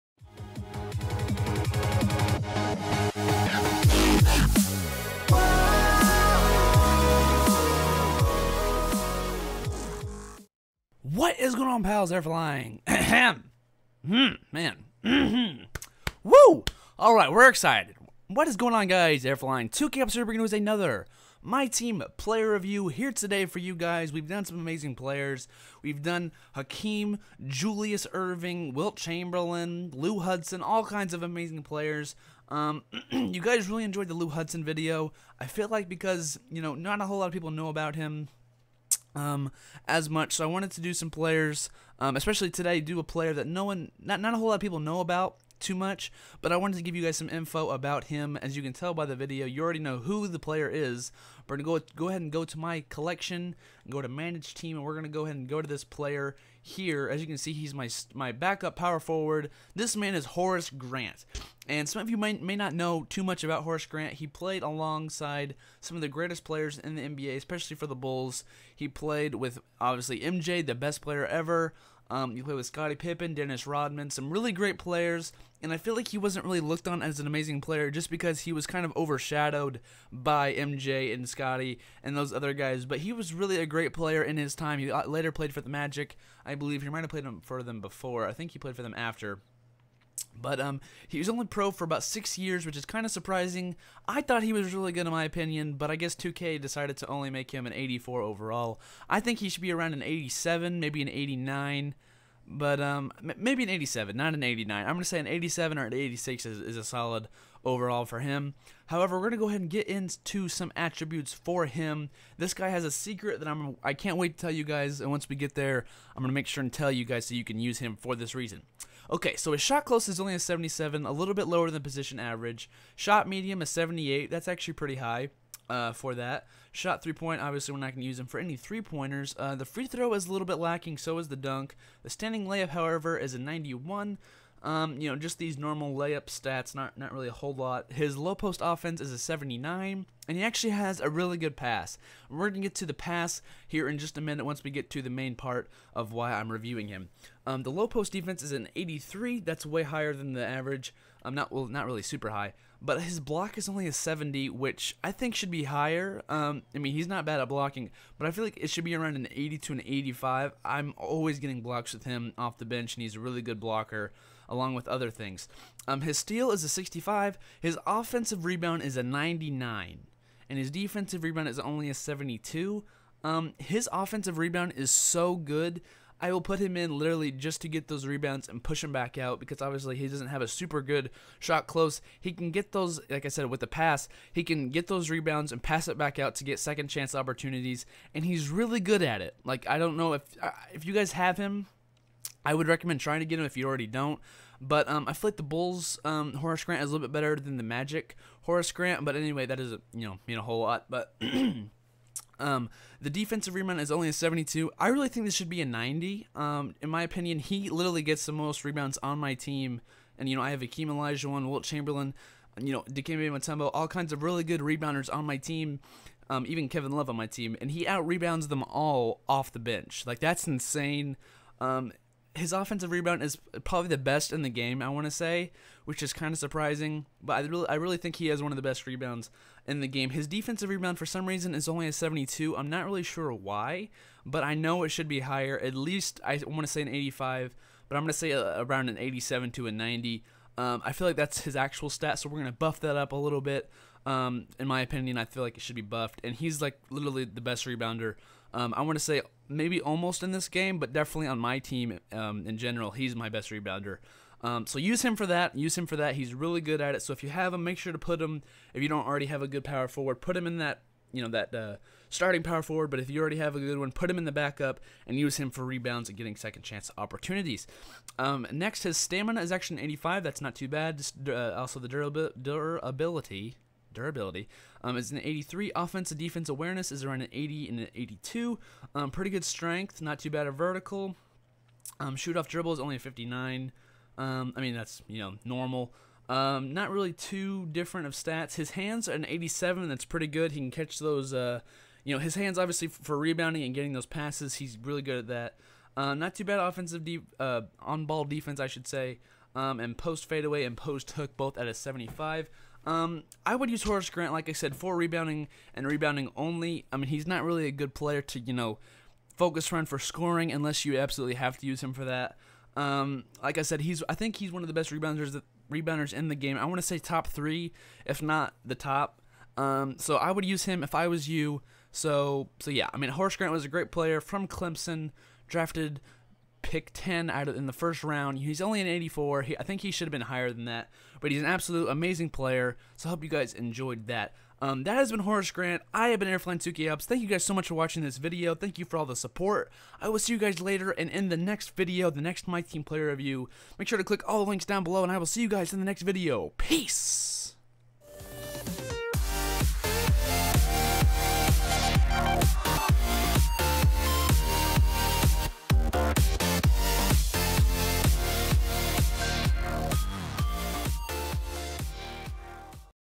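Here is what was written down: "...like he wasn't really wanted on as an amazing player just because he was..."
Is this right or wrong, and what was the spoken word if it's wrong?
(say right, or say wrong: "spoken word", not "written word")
wrong: "looked", not "wanted".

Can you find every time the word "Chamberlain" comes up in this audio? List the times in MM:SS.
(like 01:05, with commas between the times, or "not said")
00:28, 03:31.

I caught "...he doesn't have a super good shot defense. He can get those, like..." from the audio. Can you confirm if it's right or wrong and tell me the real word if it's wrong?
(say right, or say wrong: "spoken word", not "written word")
wrong: "close", not "defense".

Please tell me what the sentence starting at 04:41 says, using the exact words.
Um, shoot off dribble is only a 59.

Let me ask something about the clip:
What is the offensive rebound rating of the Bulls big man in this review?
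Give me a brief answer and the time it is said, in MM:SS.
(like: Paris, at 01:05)
99, at 02:48.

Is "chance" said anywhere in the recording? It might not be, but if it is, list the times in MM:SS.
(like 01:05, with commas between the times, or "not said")
03:06, 04:26.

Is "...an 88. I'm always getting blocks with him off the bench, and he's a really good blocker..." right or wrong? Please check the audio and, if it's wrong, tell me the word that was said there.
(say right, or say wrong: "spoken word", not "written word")
wrong: "85", not "88".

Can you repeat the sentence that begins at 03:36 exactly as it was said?
Um, even Kevin Love on my team, and he out rebounds them all off the bench.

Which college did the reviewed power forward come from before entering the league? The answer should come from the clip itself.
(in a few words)
Clemson.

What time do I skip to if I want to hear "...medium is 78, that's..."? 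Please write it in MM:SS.
02:03.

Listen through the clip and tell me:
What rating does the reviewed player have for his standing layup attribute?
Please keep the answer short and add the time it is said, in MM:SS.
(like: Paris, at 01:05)
91, at 02:13.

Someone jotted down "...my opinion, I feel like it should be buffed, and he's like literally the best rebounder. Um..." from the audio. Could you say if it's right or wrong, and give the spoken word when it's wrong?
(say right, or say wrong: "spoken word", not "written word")
right.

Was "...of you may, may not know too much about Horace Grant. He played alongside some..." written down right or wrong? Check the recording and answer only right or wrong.
right.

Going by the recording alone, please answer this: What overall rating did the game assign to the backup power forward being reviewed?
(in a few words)
84.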